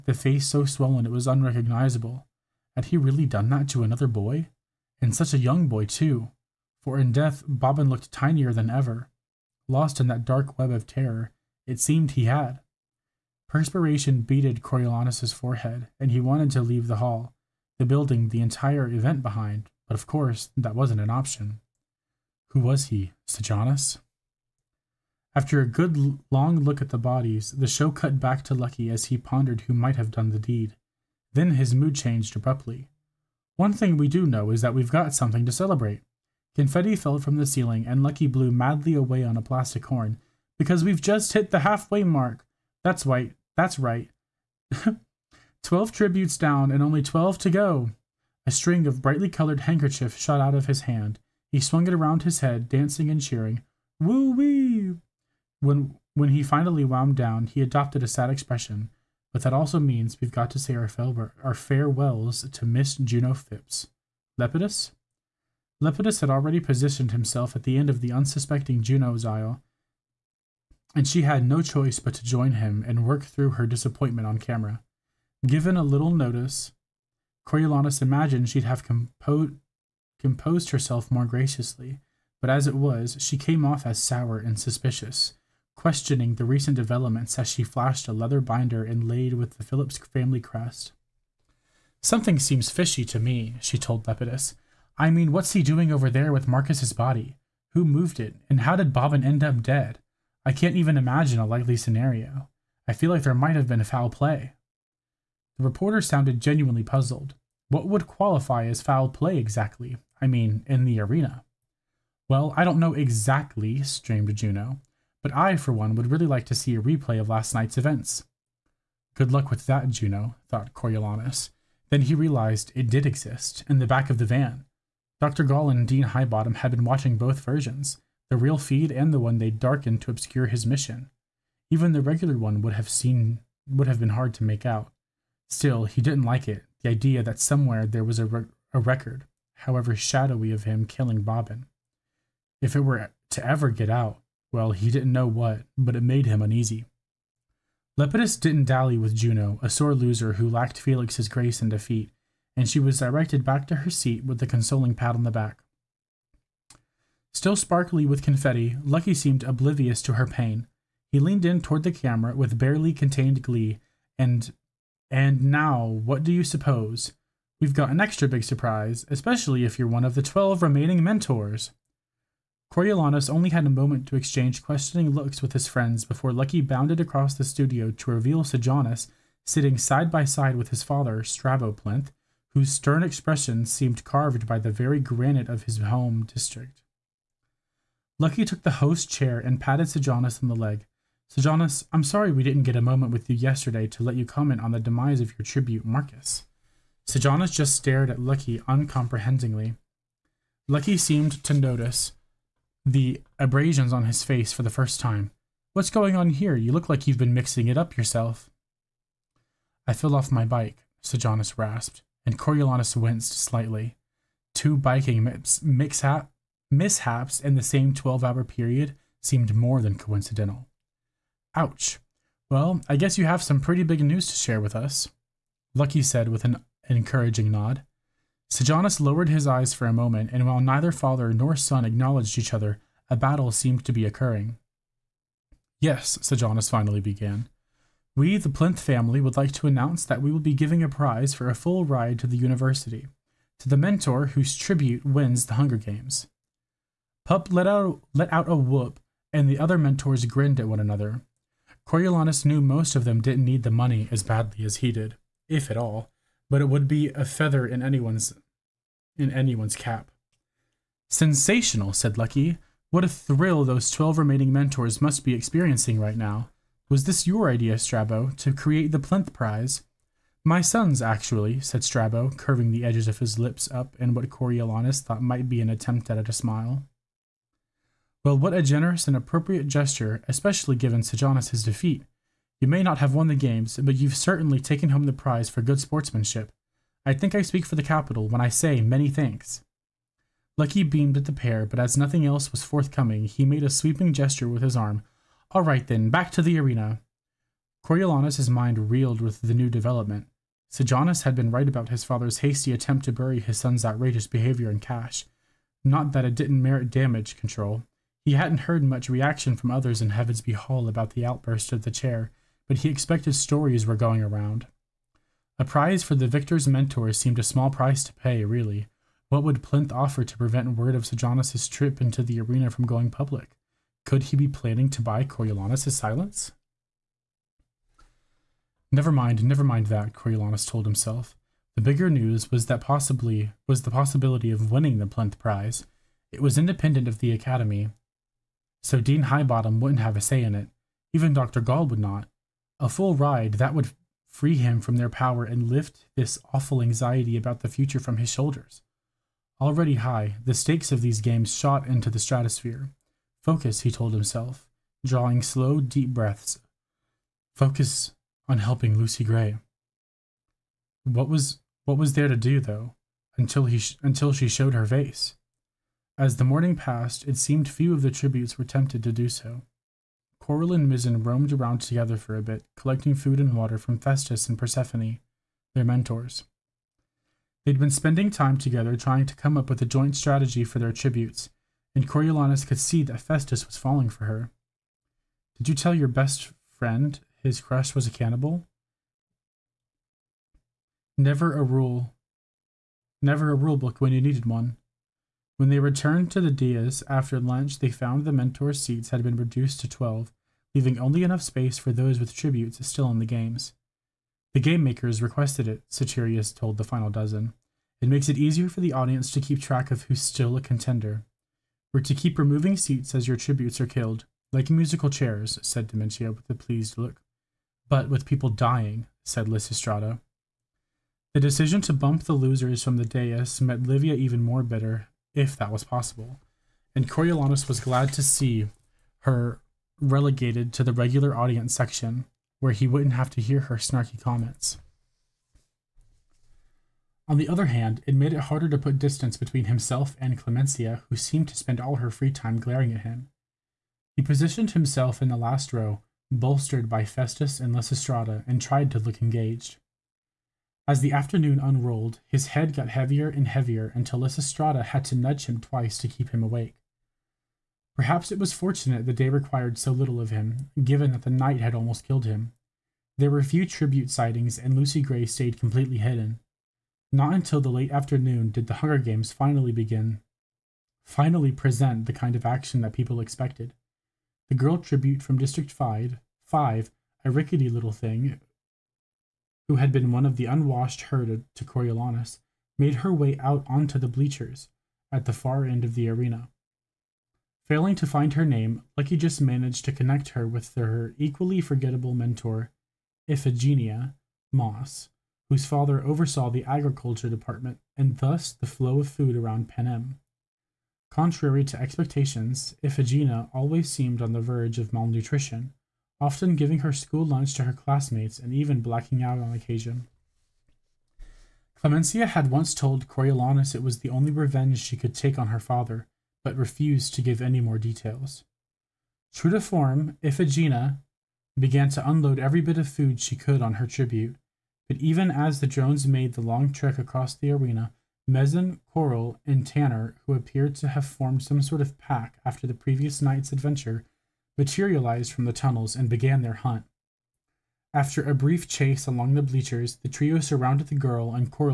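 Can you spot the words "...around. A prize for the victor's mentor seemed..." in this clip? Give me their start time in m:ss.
5:14.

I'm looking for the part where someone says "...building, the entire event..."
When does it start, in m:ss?
0:17.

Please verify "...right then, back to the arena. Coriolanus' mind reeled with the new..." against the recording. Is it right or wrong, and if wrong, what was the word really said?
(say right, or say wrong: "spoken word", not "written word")
right.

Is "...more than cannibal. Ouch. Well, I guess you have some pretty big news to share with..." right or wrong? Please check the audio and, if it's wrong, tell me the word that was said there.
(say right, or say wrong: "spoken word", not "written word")
wrong: "coincidental", not "cannibal".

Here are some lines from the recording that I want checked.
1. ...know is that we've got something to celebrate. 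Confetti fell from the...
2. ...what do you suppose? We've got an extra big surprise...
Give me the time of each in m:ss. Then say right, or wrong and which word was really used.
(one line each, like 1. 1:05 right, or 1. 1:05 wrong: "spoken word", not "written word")
1. 0:34 right
2. 2:45 right.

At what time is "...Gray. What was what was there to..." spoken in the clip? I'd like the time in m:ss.
5:59.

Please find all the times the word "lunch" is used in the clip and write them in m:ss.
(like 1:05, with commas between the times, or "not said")
6:37, 8:27.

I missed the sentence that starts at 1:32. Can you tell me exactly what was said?
Something seems fishy to me, she told Lepidus.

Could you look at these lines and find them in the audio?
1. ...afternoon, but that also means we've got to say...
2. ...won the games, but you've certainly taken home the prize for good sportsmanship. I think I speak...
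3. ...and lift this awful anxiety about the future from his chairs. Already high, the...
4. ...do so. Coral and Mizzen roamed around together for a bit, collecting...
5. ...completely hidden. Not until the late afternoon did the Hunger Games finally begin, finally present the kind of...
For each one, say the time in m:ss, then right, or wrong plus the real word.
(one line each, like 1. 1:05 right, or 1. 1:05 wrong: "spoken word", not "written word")
1. 0:58 wrong: "expression", not "afternoon"
2. 4:43 right
3. 5:45 wrong: "shoulders", not "chairs"
4. 6:09 right
5. 7:45 right.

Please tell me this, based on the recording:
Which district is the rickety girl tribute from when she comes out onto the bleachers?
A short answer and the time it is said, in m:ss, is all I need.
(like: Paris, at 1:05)
District 5, at 7:55.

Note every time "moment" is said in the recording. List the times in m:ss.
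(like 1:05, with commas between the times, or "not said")
2:53, 3:12, 3:49.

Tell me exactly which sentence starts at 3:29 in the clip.
I fell off my bike, Sejanus rasped, and Coriolanus winced slightly.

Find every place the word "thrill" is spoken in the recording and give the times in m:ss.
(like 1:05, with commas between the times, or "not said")
4:23.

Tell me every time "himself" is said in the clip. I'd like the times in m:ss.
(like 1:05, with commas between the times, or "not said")
1:07, 5:30, 5:54, 7:19, 7:24.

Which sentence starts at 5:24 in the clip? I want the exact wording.
Could he be planning to buy Coriolanus' silence?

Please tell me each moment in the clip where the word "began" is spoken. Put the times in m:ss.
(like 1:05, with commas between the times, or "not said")
3:56, 8:41, 8:56.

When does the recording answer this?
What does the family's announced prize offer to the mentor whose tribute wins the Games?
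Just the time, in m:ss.
4:01.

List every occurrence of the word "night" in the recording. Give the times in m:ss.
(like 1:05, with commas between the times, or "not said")
1:57, 7:41, 8:53.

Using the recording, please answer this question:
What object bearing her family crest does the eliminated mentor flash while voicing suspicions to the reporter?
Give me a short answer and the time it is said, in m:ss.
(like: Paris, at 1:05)
A leather binder, at 1:28.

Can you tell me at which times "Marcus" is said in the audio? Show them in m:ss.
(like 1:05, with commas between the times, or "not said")
1:36, 3:15.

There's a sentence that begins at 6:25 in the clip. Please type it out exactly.
Did you tell your best friend his crush was a cannibal?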